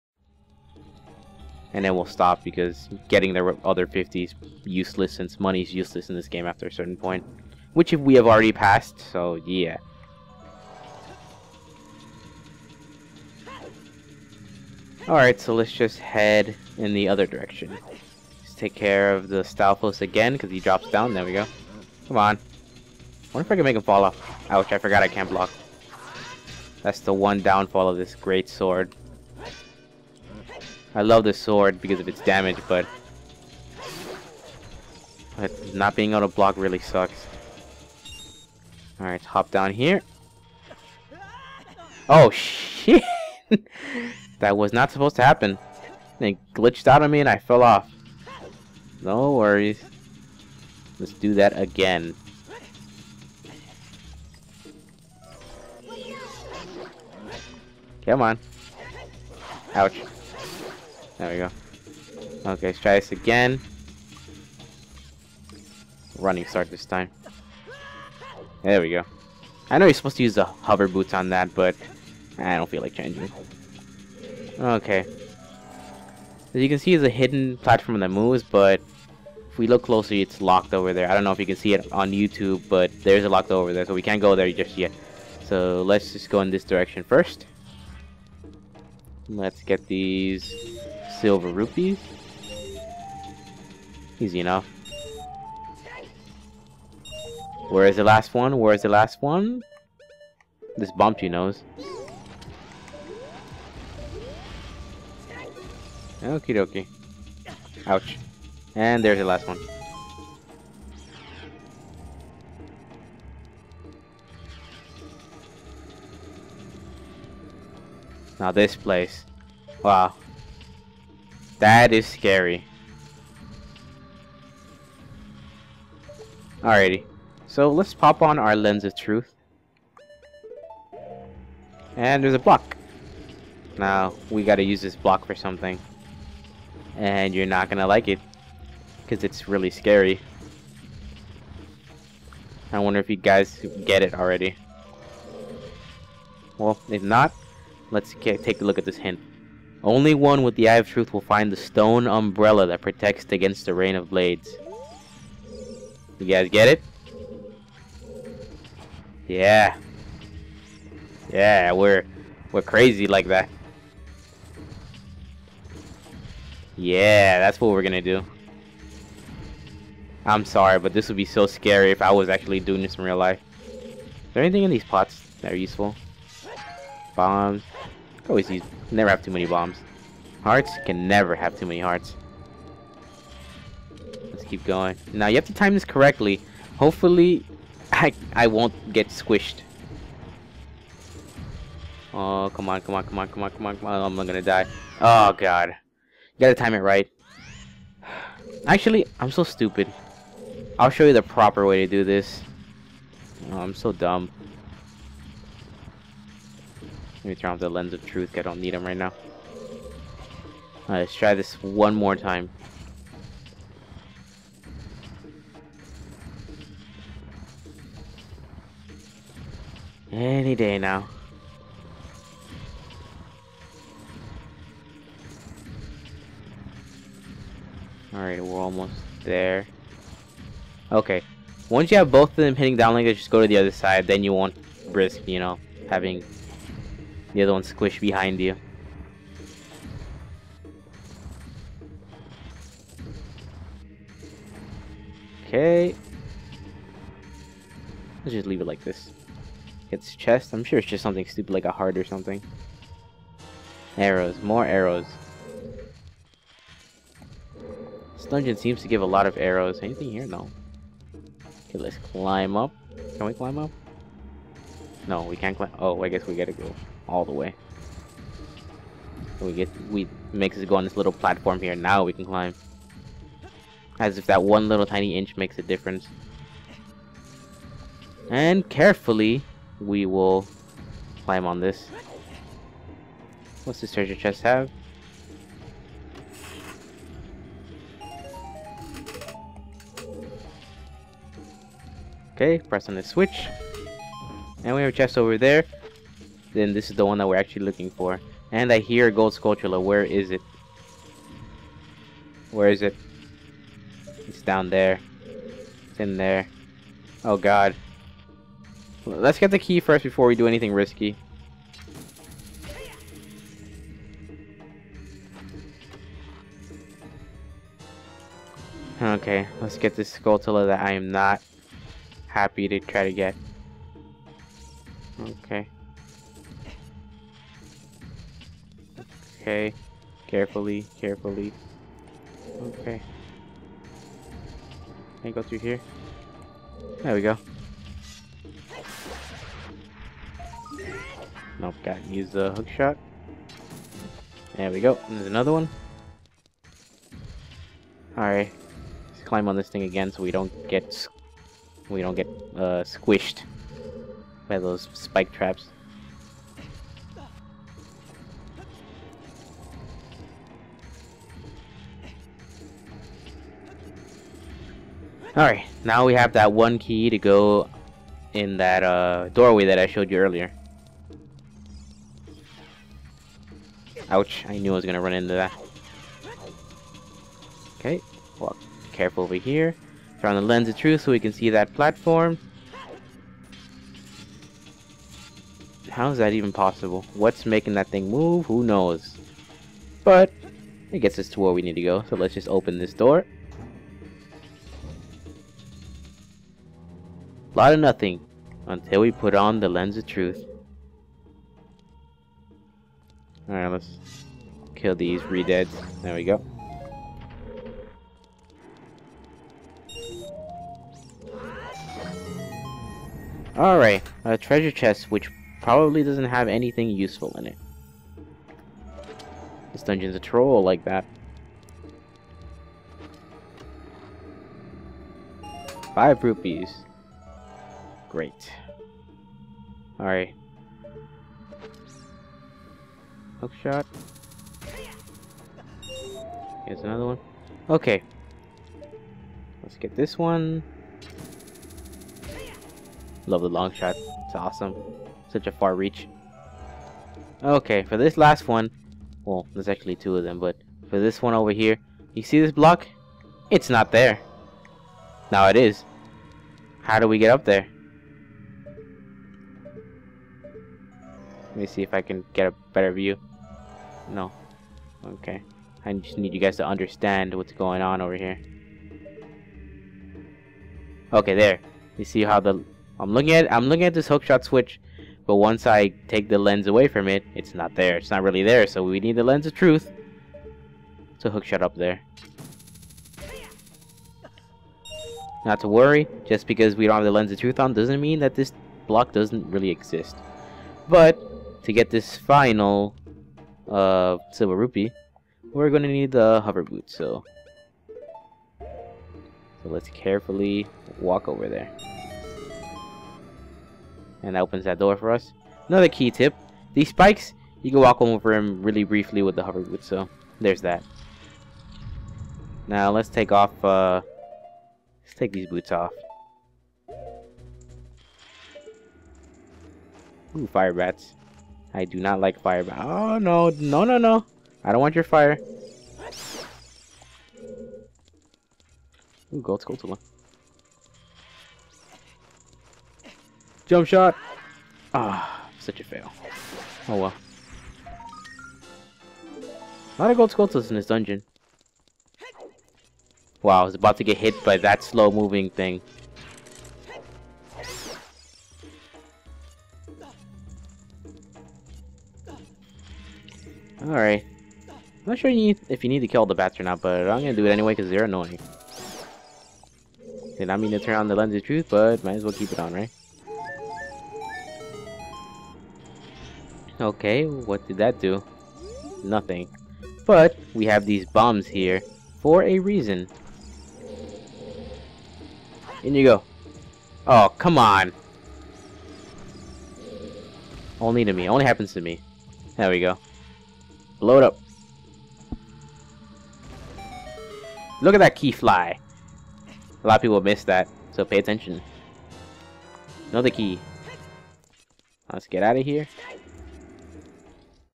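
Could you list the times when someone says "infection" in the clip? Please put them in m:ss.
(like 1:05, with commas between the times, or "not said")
not said.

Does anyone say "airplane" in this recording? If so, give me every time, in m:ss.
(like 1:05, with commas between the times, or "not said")
not said.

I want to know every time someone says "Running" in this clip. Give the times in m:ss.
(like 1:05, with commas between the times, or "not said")
1:06.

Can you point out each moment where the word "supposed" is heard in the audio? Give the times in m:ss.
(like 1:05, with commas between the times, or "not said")
0:44, 1:09.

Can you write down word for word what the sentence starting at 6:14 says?
Ouch, I knew I was gonna run into that.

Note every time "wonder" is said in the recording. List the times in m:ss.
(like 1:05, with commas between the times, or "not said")
0:23, 2:22.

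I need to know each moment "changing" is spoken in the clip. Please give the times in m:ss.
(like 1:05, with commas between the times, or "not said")
1:12.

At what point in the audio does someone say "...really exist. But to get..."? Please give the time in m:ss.
8:09.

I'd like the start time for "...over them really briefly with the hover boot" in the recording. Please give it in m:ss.
8:28.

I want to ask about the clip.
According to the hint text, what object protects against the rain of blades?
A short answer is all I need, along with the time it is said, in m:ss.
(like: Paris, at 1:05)
stone umbrella, at 2:31.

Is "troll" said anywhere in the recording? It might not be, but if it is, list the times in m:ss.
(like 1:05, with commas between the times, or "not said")
7:00.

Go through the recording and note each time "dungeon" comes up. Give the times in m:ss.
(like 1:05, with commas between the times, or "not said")
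4:18, 6:59, 9:00.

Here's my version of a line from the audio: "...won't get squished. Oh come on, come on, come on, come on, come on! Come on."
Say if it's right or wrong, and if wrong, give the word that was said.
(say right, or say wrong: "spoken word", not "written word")
right.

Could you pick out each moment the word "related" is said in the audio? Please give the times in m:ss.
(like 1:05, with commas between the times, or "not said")
not said.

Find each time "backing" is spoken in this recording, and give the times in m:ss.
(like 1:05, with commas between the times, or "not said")
not said.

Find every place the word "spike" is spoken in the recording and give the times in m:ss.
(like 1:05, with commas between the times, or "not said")
5:54, 8:26.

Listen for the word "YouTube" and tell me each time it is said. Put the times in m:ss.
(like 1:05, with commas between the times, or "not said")
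1:22.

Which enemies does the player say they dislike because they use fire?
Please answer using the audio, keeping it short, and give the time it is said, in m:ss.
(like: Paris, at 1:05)
fire bats, at 8:40.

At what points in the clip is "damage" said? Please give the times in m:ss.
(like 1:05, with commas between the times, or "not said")
0:32.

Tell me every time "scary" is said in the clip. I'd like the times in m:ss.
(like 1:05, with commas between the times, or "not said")
2:02, 2:19, 2:51.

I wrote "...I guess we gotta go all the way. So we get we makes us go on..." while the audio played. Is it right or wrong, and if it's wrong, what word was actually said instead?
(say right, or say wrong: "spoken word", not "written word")
right.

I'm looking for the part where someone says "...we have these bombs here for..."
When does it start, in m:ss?
9:30.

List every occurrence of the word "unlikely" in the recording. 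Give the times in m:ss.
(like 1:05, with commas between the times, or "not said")
not said.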